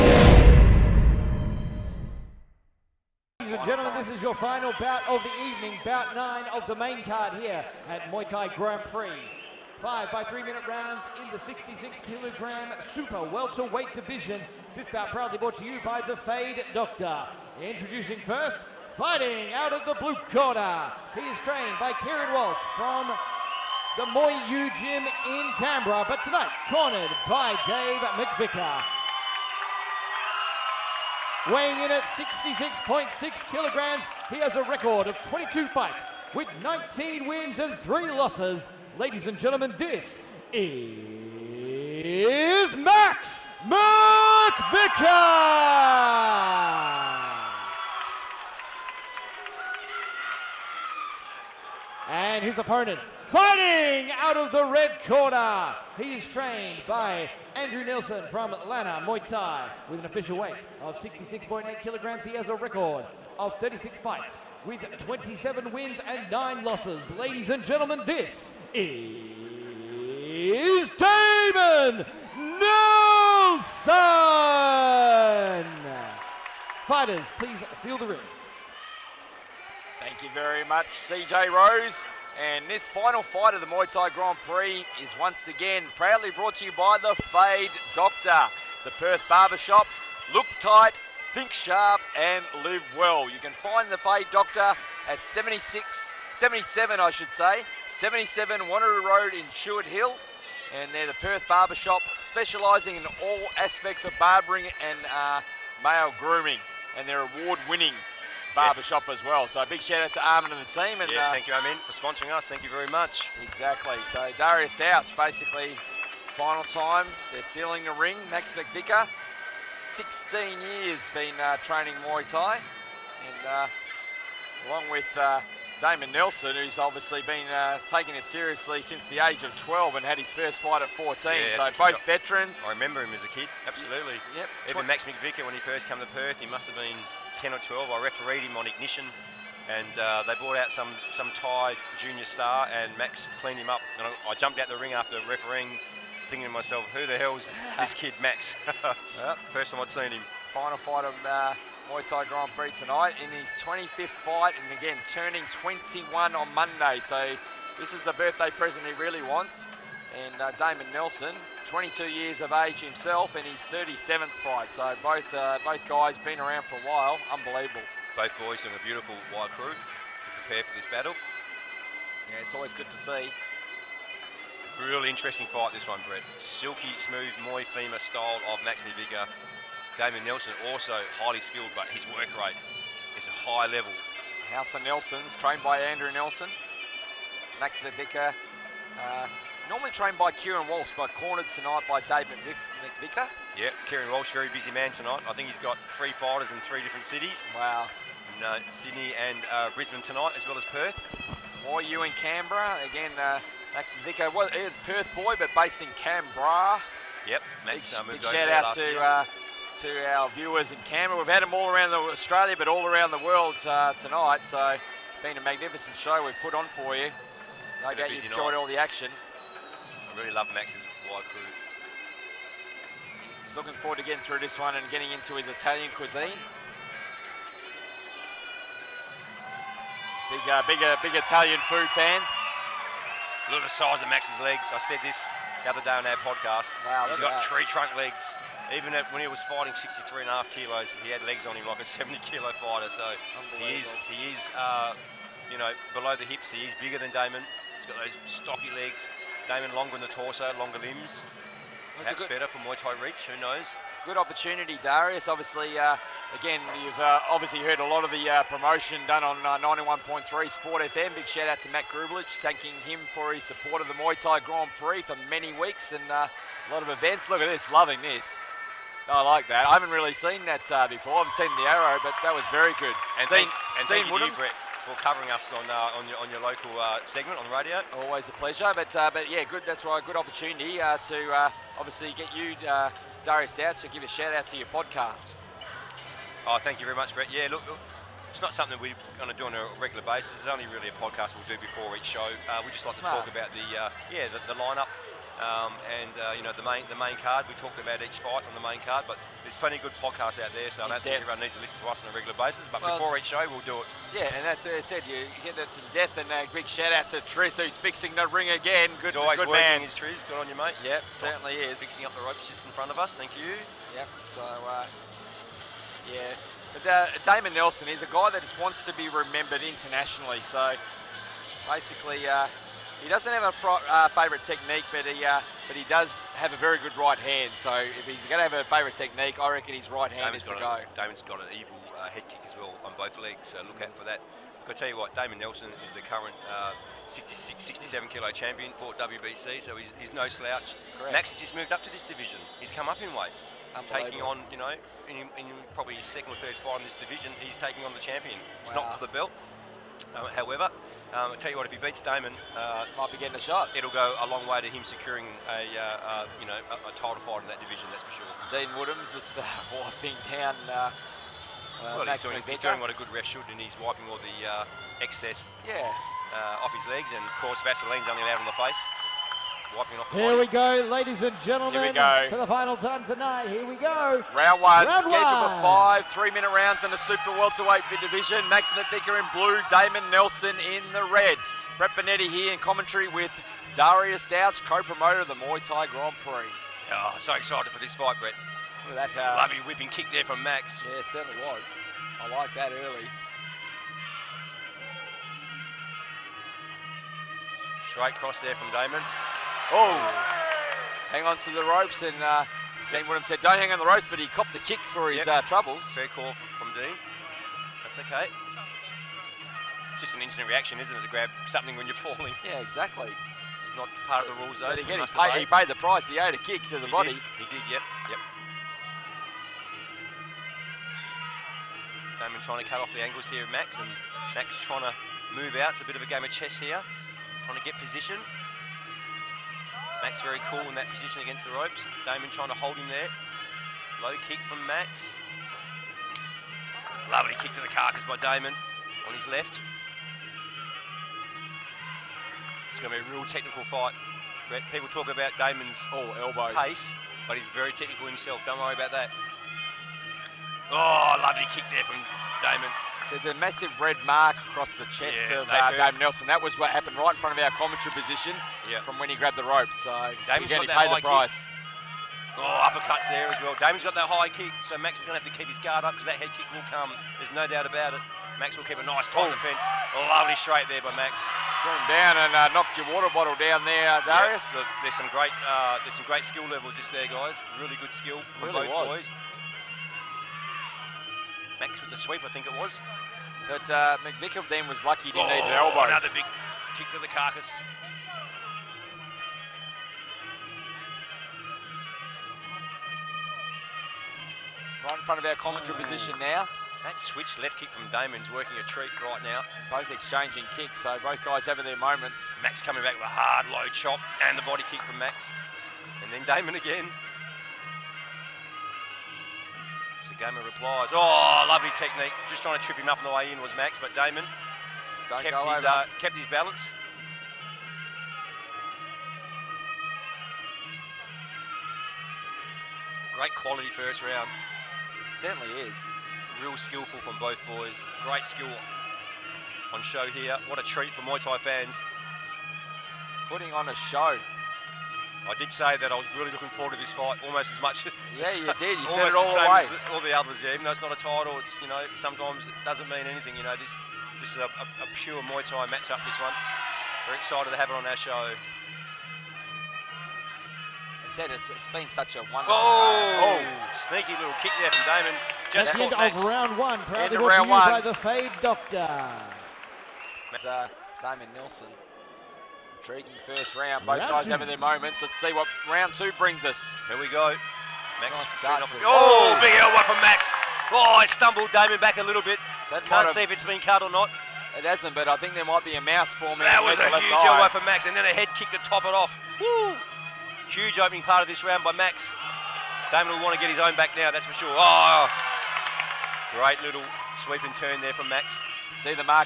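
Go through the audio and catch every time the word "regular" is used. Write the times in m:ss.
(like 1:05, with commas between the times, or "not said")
4:49, 5:02.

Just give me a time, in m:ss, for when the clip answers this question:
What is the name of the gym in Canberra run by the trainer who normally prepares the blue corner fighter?
0:24.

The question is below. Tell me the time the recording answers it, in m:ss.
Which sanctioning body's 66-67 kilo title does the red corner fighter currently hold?
5:39.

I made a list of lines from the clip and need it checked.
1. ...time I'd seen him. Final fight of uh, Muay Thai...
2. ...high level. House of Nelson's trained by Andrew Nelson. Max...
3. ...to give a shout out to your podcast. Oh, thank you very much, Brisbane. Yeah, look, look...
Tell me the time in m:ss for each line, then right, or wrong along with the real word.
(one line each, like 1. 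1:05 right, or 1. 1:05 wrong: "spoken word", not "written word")
1. 2:29 right
2. 3:03 right
3. 4:43 wrong: "Brett", not "Brisbane".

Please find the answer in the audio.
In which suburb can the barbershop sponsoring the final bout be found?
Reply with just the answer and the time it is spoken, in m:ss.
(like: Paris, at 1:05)
Tuart Hill, at 1:39.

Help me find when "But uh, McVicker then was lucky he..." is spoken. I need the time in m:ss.
8:03.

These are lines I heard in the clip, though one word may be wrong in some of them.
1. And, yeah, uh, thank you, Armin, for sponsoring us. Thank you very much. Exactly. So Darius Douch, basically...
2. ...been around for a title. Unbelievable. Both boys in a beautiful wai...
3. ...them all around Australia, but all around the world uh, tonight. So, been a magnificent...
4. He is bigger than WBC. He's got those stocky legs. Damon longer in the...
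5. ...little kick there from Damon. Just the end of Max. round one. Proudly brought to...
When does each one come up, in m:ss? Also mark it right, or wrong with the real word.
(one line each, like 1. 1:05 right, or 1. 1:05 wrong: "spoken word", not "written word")
1. 1:51 right
2. 2:46 wrong: "while", not "title"
3. 3:31 right
4. 4:06 wrong: "Damon", not "WBC"
5. 9:14 right.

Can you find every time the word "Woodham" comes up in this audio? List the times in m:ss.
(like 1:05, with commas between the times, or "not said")
5:58, 6:43.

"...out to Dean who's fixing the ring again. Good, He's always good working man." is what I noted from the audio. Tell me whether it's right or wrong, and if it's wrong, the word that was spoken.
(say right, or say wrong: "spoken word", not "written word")
wrong: "Triz", not "Dean".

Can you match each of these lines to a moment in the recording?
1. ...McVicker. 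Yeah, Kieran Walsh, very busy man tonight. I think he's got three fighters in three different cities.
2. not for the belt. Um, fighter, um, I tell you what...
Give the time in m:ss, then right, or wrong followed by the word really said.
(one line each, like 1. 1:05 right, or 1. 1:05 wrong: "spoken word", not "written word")
1. 3:12 right
2. 5:48 wrong: "however", not "fighter".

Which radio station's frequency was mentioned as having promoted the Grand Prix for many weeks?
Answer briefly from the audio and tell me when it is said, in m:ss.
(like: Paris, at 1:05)
91.3 Sport FM, at 4:19.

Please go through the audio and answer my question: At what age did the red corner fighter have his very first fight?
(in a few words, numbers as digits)
14.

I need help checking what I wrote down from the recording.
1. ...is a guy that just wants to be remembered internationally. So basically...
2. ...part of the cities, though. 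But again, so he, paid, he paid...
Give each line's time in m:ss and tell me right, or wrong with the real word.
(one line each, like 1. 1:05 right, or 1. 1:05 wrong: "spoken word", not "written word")
1. 5:17 right
2. 6:54 wrong: "rules", not "cities".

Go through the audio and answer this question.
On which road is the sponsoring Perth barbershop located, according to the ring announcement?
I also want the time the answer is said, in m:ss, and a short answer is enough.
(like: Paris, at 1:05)
Wanneroo Road, at 1:38.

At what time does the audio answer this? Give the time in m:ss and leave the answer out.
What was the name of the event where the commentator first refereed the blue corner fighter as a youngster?
2:18.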